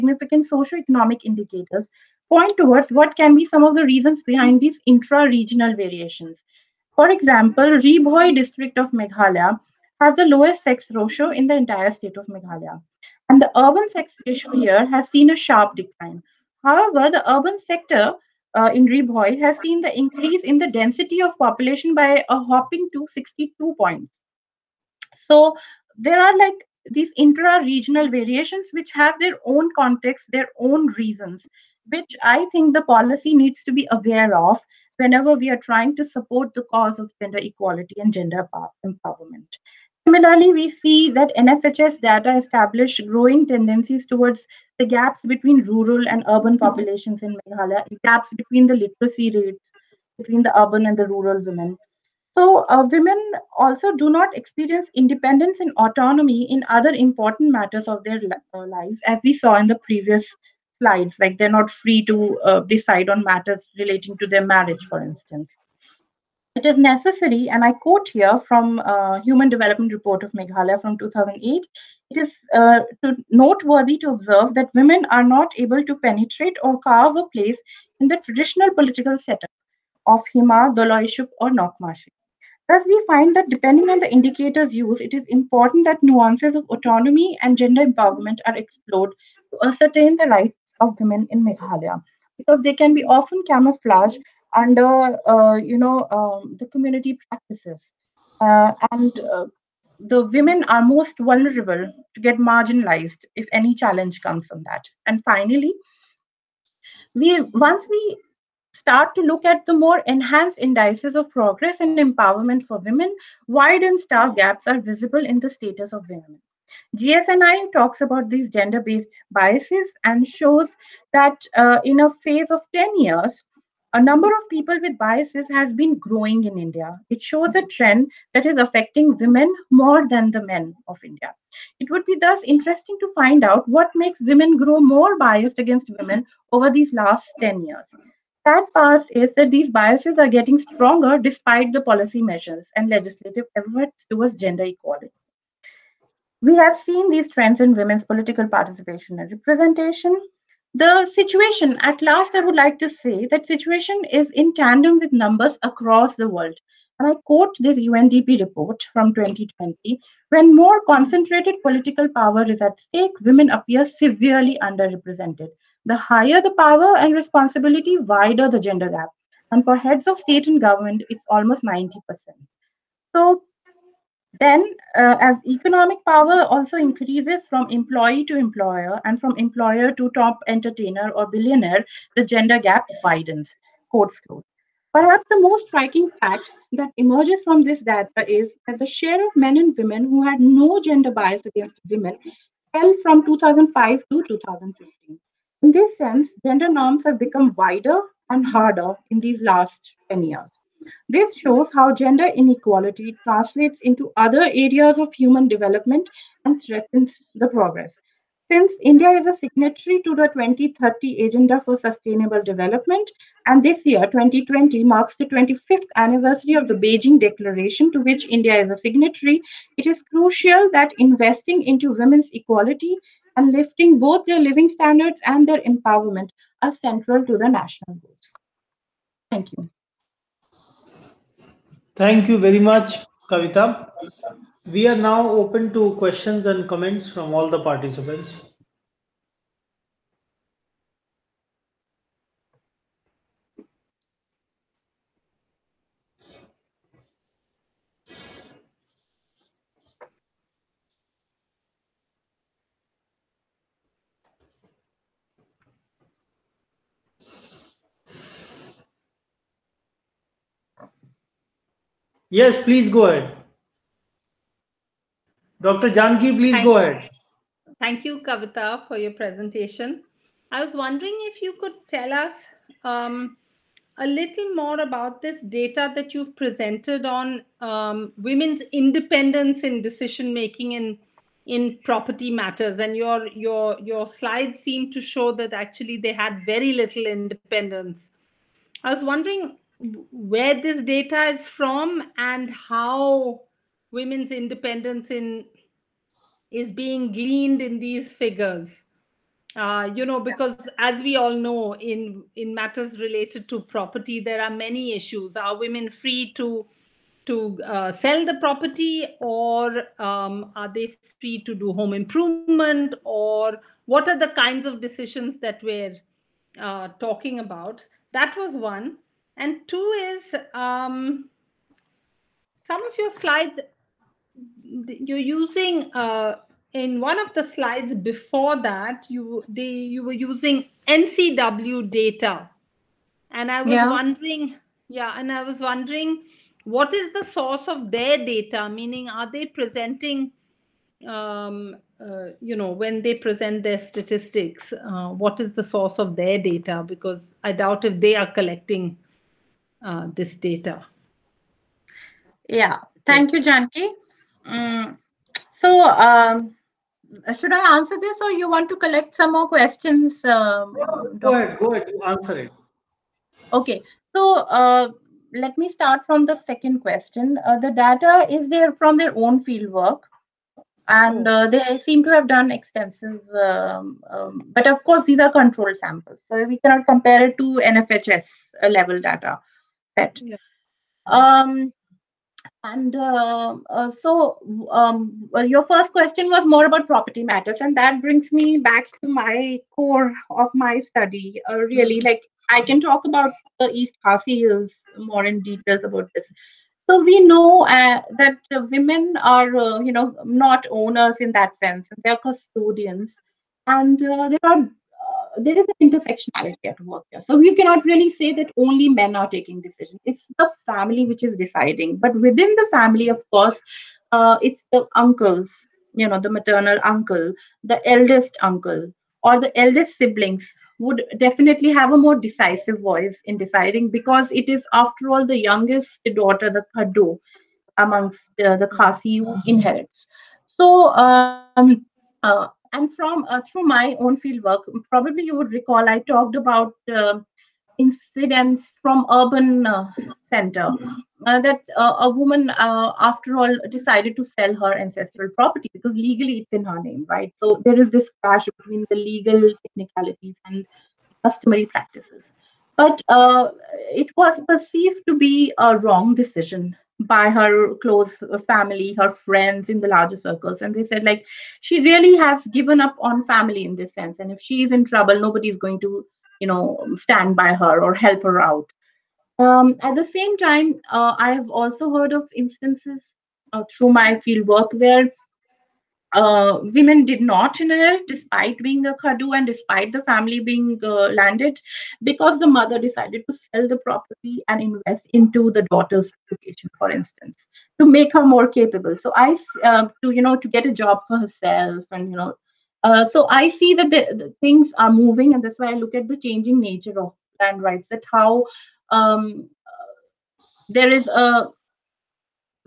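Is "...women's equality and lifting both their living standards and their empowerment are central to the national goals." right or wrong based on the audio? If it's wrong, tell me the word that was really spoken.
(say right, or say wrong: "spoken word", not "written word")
right.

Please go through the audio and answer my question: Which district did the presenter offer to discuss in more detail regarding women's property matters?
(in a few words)
East Khasi Hills.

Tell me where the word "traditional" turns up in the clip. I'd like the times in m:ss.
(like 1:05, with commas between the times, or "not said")
1:18.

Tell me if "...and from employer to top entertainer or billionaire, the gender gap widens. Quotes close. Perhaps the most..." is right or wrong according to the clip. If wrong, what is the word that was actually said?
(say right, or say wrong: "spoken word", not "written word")
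right.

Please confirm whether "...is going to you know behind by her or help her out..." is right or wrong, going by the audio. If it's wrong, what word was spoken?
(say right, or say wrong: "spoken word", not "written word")
wrong: "stand", not "behind".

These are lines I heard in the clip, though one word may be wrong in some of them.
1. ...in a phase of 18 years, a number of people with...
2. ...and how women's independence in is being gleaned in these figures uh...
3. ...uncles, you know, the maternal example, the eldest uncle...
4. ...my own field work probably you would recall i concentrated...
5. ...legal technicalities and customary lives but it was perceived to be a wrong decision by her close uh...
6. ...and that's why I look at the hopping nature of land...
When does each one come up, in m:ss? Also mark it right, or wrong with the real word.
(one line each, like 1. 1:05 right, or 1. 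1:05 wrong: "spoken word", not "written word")
1. 2:01 wrong: "10", not "18"
2. 4:52 right
3. 6:54 wrong: "uncle", not "example"
4. 7:13 wrong: "talked", not "concentrated"
5. 7:28 wrong: "practices", not "lives"
6. 8:15 wrong: "changing", not "hopping".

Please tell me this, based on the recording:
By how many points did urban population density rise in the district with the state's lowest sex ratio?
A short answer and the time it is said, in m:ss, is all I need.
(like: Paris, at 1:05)
62, at 0:23.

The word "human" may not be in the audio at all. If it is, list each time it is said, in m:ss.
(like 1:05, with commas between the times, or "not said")
1:09, 3:25.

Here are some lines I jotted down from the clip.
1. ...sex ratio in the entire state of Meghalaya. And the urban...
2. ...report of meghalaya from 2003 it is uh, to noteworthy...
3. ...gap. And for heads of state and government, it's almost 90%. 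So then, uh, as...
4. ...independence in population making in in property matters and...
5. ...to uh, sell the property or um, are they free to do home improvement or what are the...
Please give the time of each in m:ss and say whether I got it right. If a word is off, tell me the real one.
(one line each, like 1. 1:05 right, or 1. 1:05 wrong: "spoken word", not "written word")
1. 0:10 right
2. 1:09 wrong: "2008", not "2003"
3. 2:48 right
4. 4:38 wrong: "decision", not "population"
5. 5:07 right.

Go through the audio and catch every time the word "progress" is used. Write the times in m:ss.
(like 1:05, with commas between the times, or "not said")
1:51, 3:27.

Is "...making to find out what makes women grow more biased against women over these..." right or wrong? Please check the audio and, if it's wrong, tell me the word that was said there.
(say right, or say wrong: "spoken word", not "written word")
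wrong: "interesting", not "making".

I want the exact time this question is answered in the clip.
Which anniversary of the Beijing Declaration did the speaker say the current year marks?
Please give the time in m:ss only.
3:35.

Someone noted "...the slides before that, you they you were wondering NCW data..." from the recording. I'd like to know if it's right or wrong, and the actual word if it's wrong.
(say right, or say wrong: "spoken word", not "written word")
wrong: "using", not "wondering".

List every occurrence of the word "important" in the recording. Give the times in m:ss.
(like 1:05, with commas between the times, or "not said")
0:56, 1:25.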